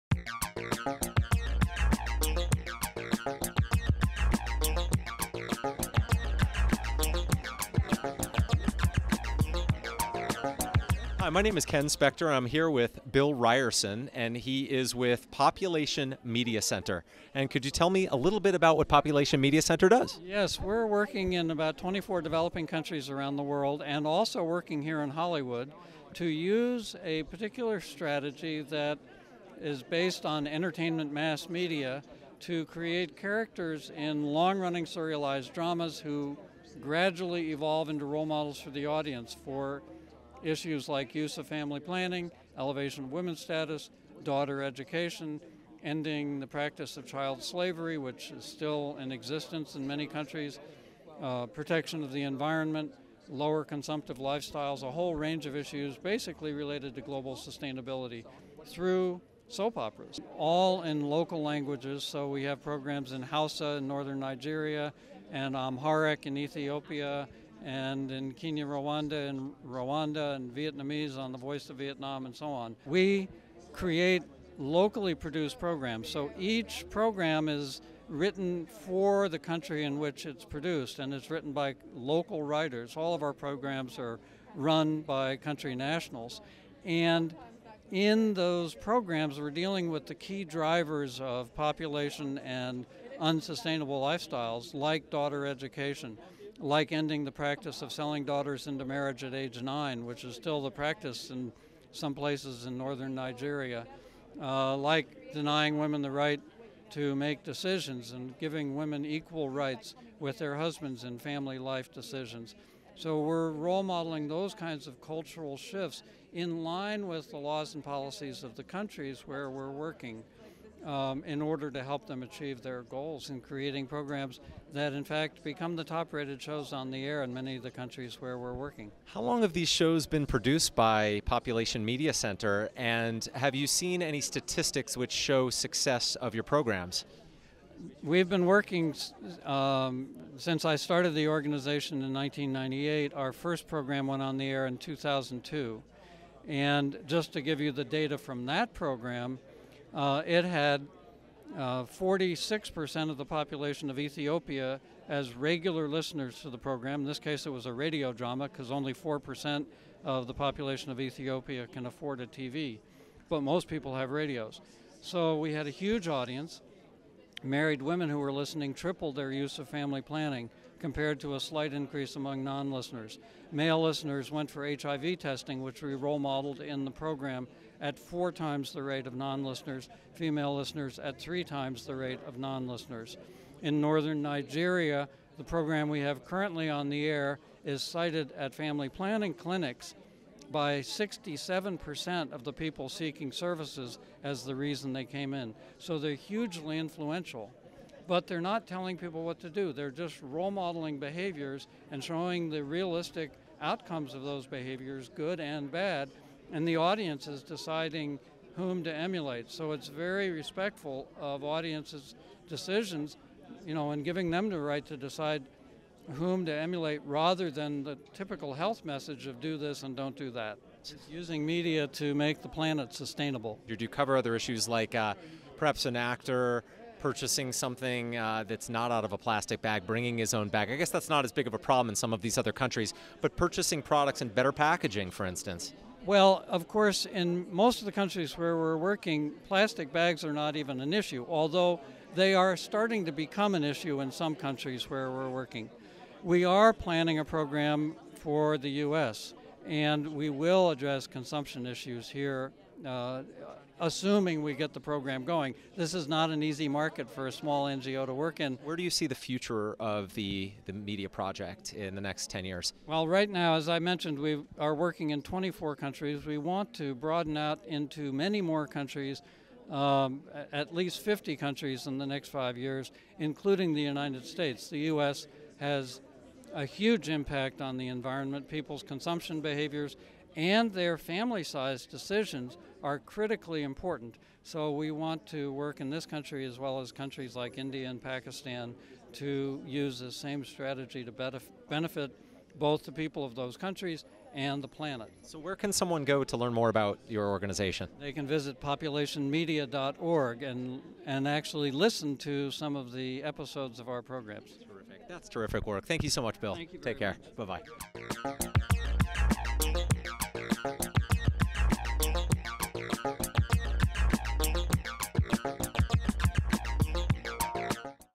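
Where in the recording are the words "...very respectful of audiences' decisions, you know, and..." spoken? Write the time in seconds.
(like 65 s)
209 s.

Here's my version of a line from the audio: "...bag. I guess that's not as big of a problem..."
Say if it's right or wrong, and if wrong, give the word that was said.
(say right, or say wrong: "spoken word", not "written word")
right.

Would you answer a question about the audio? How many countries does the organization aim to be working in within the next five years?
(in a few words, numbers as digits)
50.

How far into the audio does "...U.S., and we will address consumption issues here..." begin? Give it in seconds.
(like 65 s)
248 s.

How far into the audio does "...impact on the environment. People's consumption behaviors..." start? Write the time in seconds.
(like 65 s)
277 s.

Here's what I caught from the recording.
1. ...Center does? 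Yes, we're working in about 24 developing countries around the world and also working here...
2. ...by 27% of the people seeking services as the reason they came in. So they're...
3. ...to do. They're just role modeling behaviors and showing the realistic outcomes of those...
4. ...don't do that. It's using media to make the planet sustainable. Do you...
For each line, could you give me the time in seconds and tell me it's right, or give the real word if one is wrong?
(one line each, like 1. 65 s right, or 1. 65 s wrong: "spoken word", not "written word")
1. 19 s right
2. 190 s wrong: "67", not "27"
3. 199 s right
4. 219 s right.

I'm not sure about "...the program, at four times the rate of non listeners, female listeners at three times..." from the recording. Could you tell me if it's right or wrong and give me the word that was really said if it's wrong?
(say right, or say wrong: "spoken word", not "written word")
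right.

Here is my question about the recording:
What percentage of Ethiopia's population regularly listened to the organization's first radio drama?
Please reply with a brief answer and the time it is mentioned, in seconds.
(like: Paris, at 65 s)
46%, at 151 s.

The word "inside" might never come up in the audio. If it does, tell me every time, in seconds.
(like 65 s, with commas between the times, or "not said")
not said.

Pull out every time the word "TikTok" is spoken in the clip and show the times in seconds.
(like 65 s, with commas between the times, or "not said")
not said.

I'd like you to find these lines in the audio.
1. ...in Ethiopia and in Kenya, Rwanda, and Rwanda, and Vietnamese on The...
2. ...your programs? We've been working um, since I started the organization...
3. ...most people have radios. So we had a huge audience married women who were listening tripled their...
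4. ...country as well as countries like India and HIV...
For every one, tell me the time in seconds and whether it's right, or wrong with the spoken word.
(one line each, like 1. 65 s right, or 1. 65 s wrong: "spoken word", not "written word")
1. 66 s right
2. 136 s right
3. 163 s right
4. 286 s wrong: "Pakistan", not "HIV".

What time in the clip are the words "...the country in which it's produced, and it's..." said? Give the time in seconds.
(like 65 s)
79 s.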